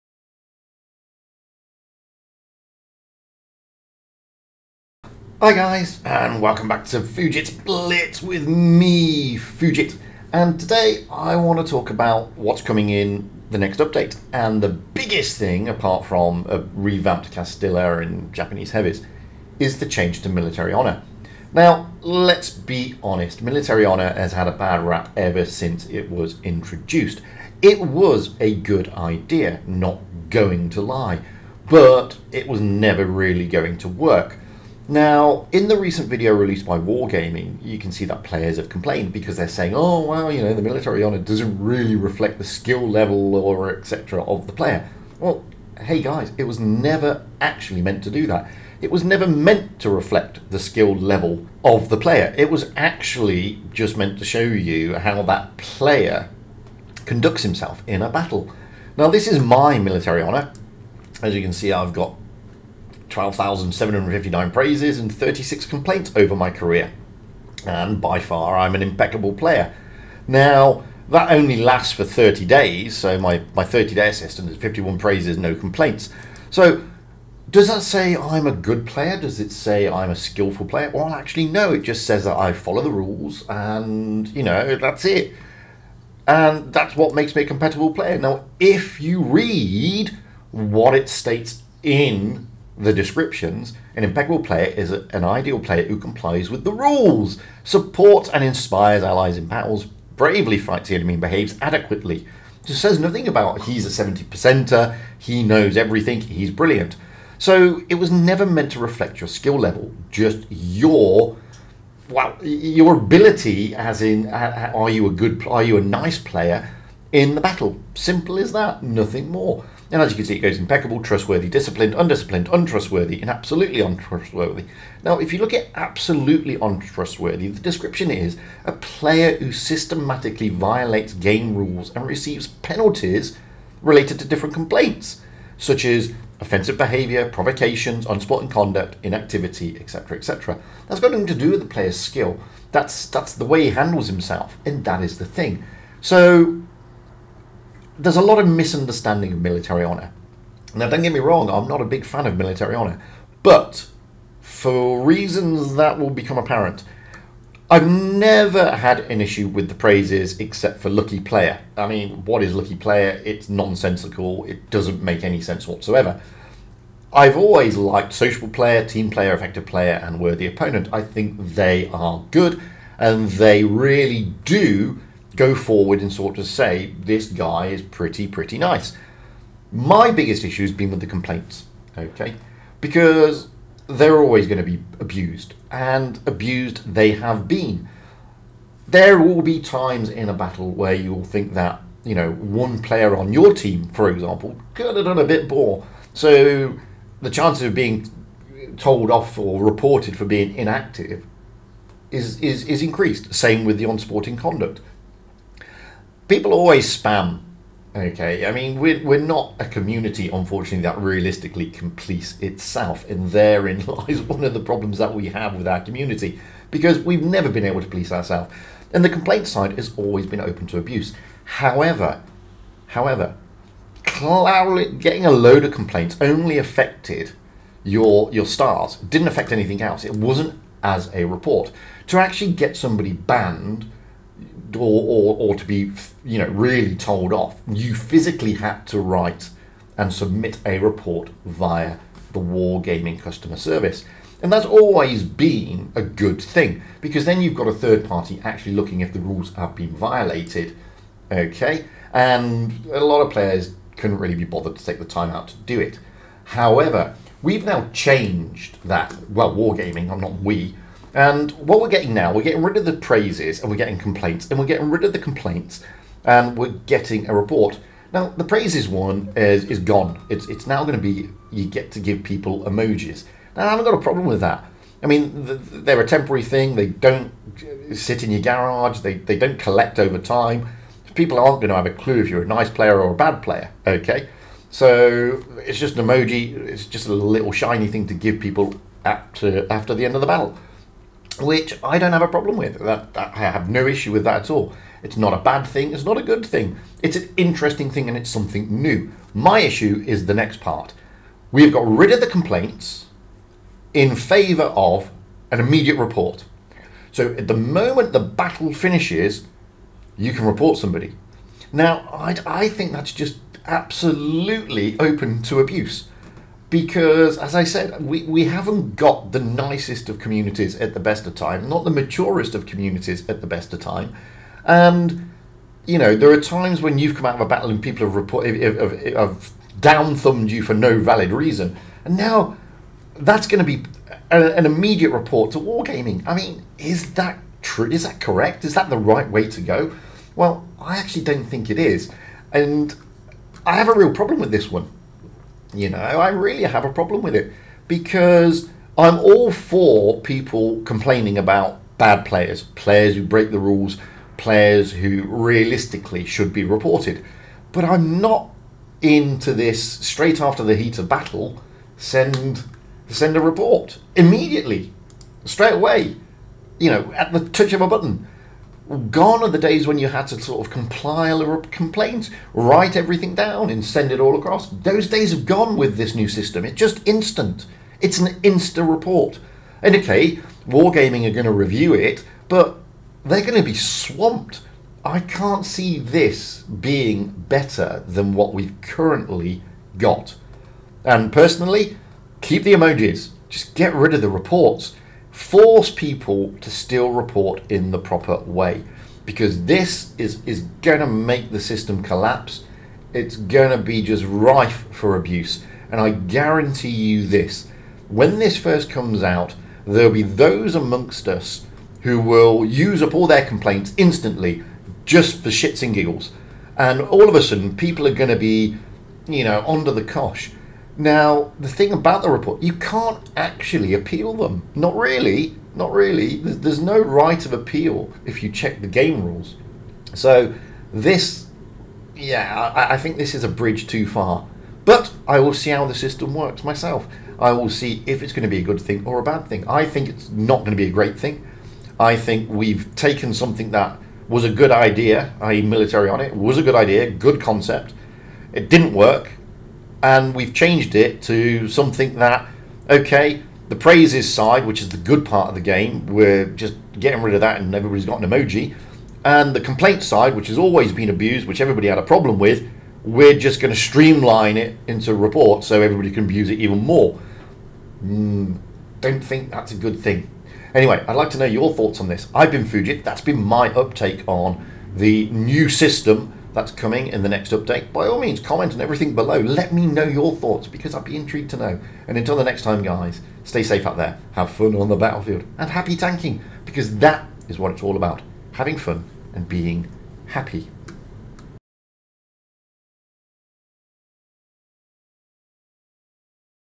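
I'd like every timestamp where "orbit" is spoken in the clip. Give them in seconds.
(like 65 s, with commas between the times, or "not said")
not said.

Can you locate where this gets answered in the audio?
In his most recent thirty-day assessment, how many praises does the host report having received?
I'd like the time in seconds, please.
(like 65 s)
74 s.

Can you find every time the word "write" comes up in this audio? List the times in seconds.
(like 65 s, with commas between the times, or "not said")
238 s, 372 s.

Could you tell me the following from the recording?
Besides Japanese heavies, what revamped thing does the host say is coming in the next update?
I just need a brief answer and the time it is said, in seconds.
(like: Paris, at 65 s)
Castilla, at 17 s.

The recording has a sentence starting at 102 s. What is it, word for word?
Just says nothing about he's a 70 percenter, he knows everything, he's brilliant.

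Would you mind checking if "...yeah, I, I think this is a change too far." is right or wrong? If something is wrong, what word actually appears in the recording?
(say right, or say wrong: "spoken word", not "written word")
wrong: "bridge", not "change".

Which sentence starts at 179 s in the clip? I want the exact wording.
My biggest issue has been with the complaints, okay, because they're always going to be abused, and abused they have been.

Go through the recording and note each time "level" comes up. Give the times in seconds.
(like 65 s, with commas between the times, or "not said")
42 s, 50 s, 109 s.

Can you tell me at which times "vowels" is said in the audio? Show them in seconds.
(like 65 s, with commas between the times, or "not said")
not said.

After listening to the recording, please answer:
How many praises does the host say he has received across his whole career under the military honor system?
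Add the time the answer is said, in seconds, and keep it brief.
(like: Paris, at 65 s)
12,759, at 63 s.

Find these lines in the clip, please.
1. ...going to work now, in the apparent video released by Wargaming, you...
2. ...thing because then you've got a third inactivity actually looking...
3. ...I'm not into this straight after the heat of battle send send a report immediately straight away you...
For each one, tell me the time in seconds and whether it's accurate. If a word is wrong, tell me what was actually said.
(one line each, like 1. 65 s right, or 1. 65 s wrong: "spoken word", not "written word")
1. 33 s wrong: "recent", not "apparent"
2. 246 s wrong: "party", not "inactivity"
3. 357 s right.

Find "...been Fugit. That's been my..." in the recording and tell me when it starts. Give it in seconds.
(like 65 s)
472 s.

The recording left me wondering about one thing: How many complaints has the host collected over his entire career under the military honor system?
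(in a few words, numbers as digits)
36.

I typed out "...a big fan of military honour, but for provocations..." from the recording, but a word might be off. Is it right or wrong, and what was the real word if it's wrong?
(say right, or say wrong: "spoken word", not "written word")
wrong: "reasons", not "provocations".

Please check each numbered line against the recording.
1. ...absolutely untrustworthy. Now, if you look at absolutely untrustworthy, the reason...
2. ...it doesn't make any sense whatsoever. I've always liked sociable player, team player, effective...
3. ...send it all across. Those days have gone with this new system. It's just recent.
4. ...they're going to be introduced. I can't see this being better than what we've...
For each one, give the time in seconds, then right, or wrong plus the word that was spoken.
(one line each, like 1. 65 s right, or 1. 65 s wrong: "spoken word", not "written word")
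1. 123 s wrong: "description", not "reason"
2. 164 s right
3. 373 s wrong: "instant", not "recent"
4. 383 s wrong: "swamped", not "introduced".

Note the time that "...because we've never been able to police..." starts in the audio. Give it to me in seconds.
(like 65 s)
216 s.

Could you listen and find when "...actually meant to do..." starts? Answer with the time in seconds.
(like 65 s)
47 s.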